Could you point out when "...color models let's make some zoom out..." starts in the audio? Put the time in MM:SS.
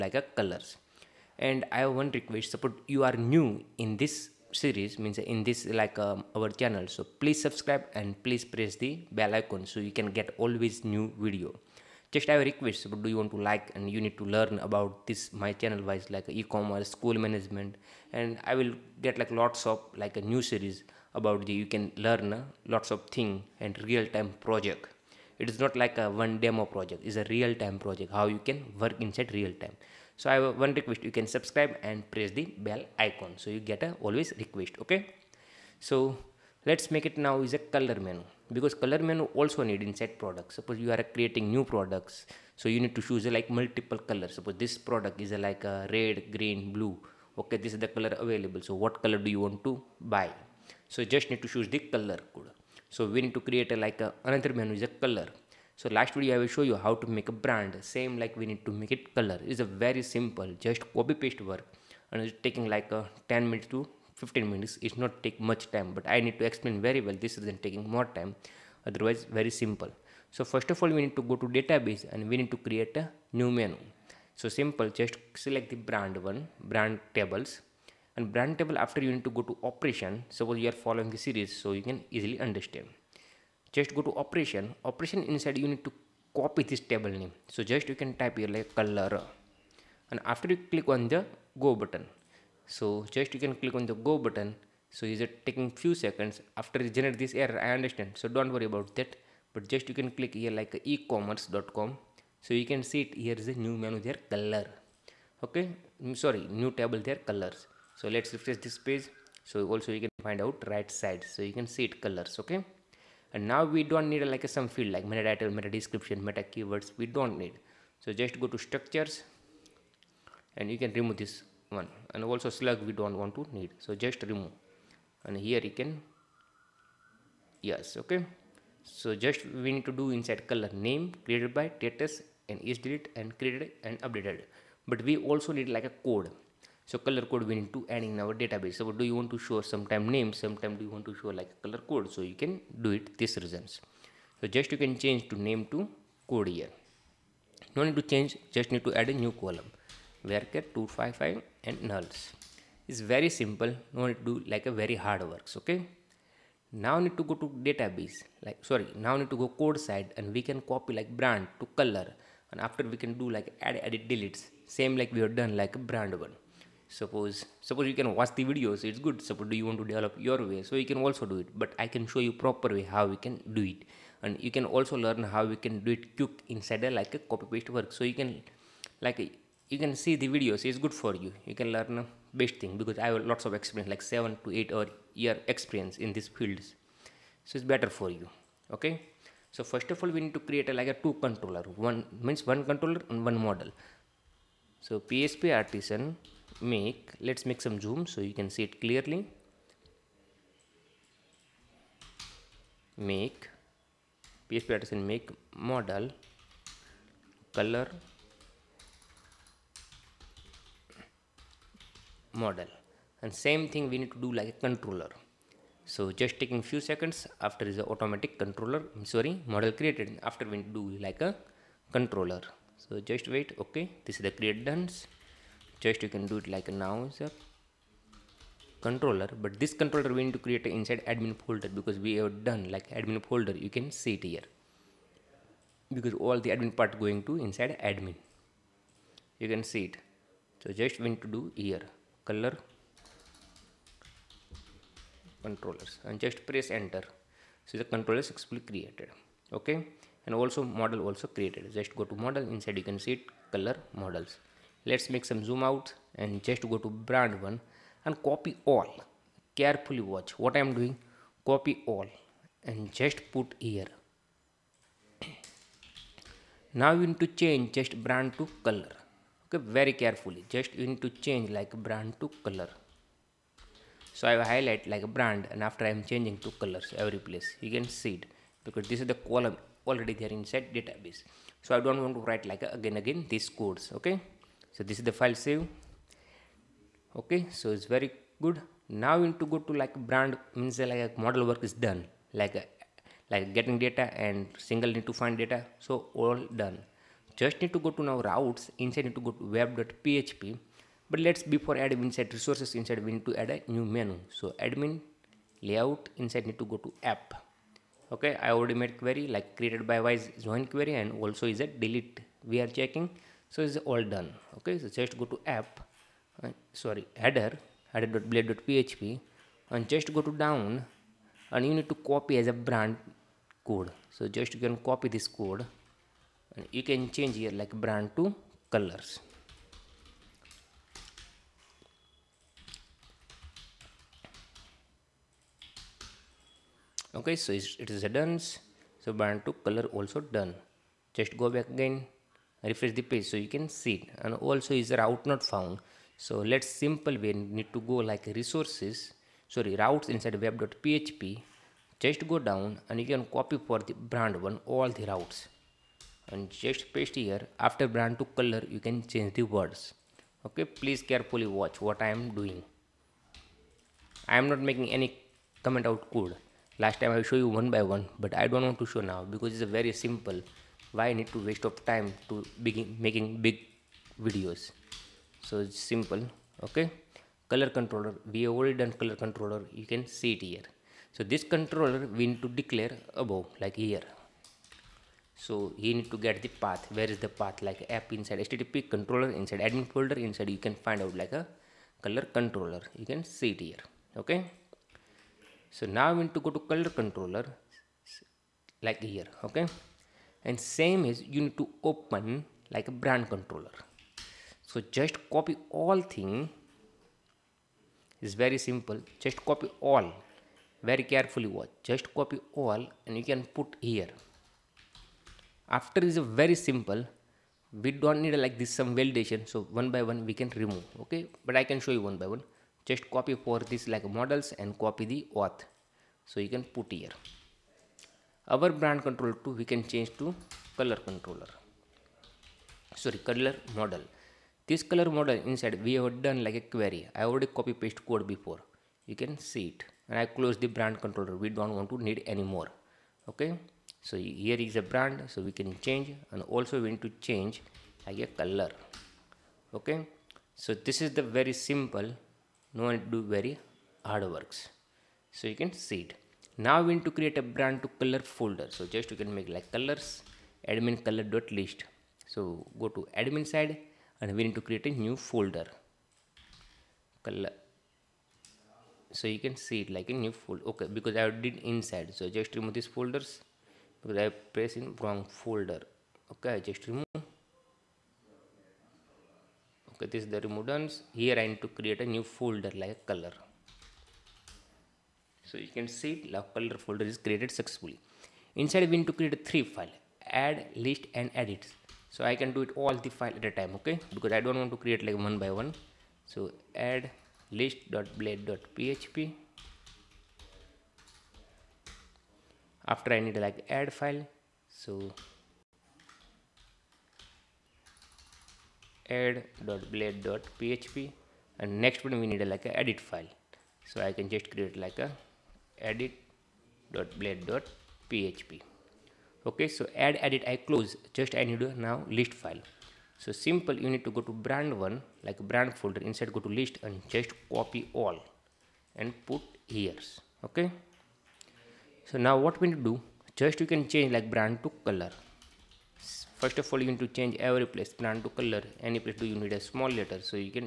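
04:13.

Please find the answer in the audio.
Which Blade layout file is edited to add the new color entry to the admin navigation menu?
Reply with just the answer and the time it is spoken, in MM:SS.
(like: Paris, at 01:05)
header.blade.php, at 05:17.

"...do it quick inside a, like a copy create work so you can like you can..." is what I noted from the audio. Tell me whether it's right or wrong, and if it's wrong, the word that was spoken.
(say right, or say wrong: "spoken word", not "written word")
wrong: "paste", not "create".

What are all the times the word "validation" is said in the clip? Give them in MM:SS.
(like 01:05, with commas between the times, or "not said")
06:59.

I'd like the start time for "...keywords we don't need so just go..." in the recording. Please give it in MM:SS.
01:56.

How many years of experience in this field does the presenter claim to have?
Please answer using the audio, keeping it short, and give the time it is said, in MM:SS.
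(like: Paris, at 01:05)
7 to 8, at 03:04.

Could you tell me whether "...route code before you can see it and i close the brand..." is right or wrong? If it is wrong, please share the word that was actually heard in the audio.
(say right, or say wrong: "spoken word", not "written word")
wrong: "paste", not "route".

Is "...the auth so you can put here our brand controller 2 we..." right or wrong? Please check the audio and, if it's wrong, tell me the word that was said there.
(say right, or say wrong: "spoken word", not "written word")
right.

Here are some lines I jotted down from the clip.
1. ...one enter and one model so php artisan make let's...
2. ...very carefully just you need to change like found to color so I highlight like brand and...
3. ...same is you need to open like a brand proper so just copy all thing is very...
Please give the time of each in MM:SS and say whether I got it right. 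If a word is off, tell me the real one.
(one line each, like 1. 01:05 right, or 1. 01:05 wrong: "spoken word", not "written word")
1. 03:12 wrong: "controller", not "enter"
2. 04:29 wrong: "brand", not "found"
3. 06:40 wrong: "controller", not "proper".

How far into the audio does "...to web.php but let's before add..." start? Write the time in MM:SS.
04:59.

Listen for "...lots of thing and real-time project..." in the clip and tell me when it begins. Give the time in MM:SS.
00:22.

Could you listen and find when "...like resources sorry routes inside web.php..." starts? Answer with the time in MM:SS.
05:48.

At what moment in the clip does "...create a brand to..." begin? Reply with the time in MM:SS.
07:37.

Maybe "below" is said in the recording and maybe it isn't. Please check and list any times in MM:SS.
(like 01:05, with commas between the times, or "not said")
not said.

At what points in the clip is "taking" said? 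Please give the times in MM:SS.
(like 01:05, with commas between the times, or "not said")
01:02, 01:07, 01:35, 03:36.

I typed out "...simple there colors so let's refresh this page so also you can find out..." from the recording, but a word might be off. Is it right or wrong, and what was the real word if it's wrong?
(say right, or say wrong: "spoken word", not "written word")
wrong: "table", not "simple".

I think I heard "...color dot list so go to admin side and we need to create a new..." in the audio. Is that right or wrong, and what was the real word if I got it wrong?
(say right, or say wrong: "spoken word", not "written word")
right.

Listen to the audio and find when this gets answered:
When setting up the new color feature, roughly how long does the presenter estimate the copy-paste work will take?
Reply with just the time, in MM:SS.
01:03.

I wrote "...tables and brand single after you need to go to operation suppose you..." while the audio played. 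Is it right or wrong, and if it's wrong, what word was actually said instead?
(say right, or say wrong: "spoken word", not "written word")
wrong: "table", not "single".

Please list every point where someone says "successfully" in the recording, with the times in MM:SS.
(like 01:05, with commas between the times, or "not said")
04:08, 08:07.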